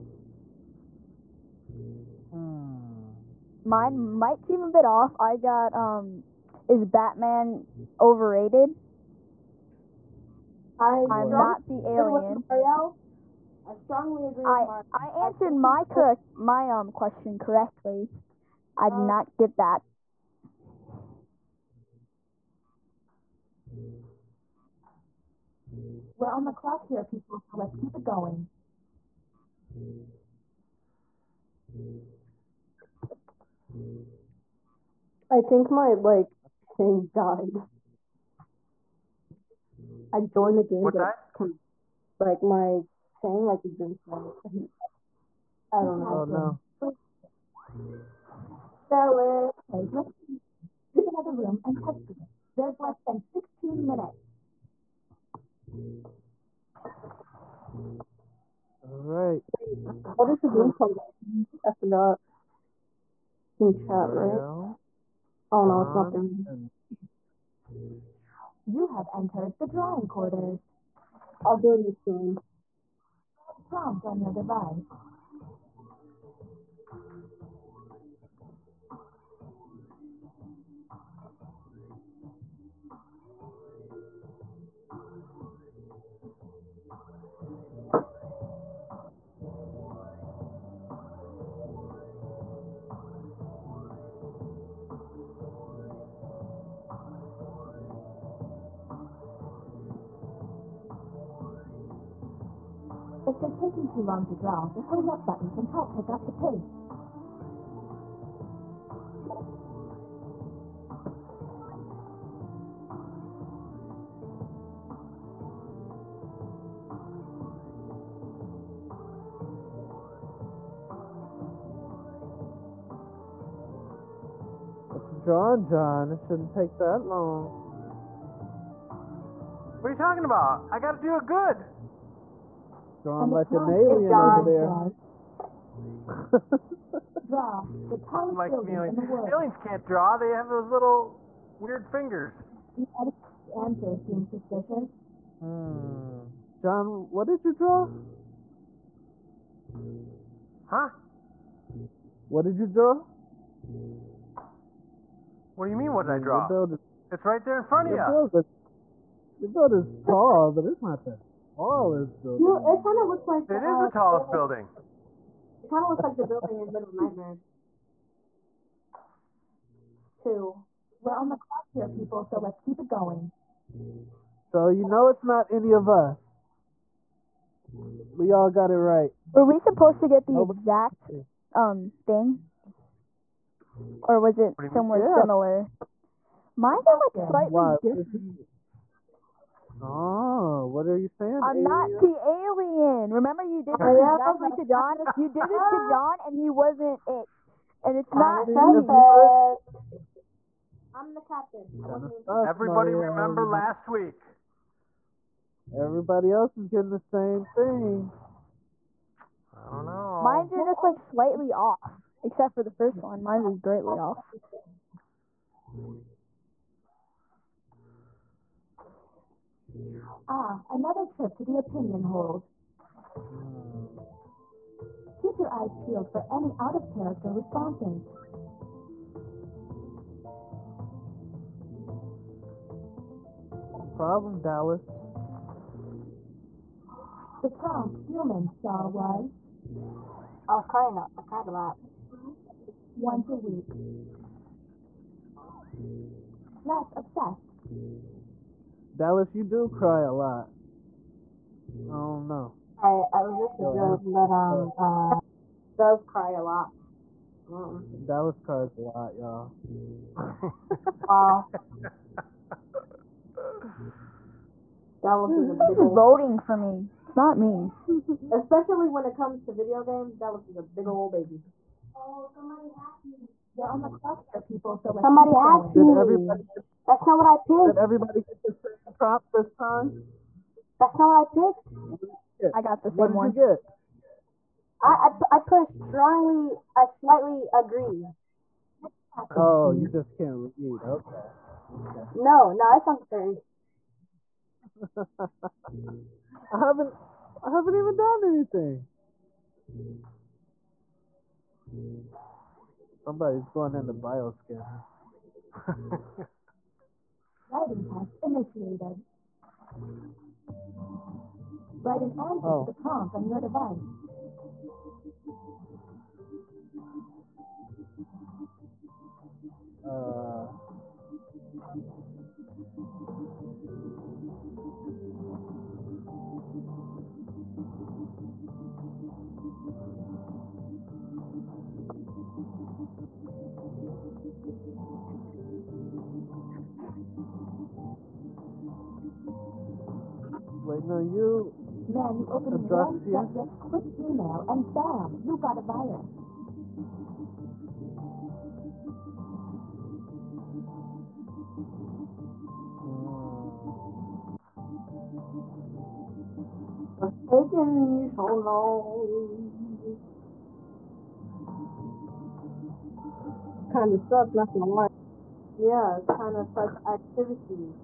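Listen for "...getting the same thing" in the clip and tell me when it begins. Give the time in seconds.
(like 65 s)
206 s.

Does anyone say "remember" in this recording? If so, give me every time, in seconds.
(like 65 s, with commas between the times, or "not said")
193 s, 203 s.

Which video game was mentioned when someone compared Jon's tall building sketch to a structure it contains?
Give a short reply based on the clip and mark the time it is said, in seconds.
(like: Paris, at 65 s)
Little Nightmares, at 166 s.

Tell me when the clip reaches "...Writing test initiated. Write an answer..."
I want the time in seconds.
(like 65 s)
307 s.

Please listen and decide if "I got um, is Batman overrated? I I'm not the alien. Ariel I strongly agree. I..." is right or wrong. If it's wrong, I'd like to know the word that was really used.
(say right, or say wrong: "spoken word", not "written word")
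right.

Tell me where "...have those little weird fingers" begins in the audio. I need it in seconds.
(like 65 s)
140 s.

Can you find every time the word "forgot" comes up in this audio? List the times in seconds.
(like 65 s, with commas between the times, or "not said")
61 s.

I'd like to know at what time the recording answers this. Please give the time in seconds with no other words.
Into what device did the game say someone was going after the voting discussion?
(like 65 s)
303 s.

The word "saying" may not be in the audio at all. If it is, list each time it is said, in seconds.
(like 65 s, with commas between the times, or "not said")
43 s, 191 s.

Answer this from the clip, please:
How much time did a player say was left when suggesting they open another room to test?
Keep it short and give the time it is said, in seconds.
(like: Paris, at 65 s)
Less than 16 minutes, at 52 s.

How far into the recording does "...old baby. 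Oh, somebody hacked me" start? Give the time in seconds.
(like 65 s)
270 s.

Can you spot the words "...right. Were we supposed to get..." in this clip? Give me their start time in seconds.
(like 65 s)
178 s.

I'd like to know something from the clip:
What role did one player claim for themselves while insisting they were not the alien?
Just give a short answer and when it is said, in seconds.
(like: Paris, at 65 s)
The captain, at 201 s.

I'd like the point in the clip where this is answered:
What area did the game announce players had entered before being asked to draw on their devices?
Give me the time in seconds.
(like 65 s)
69 s.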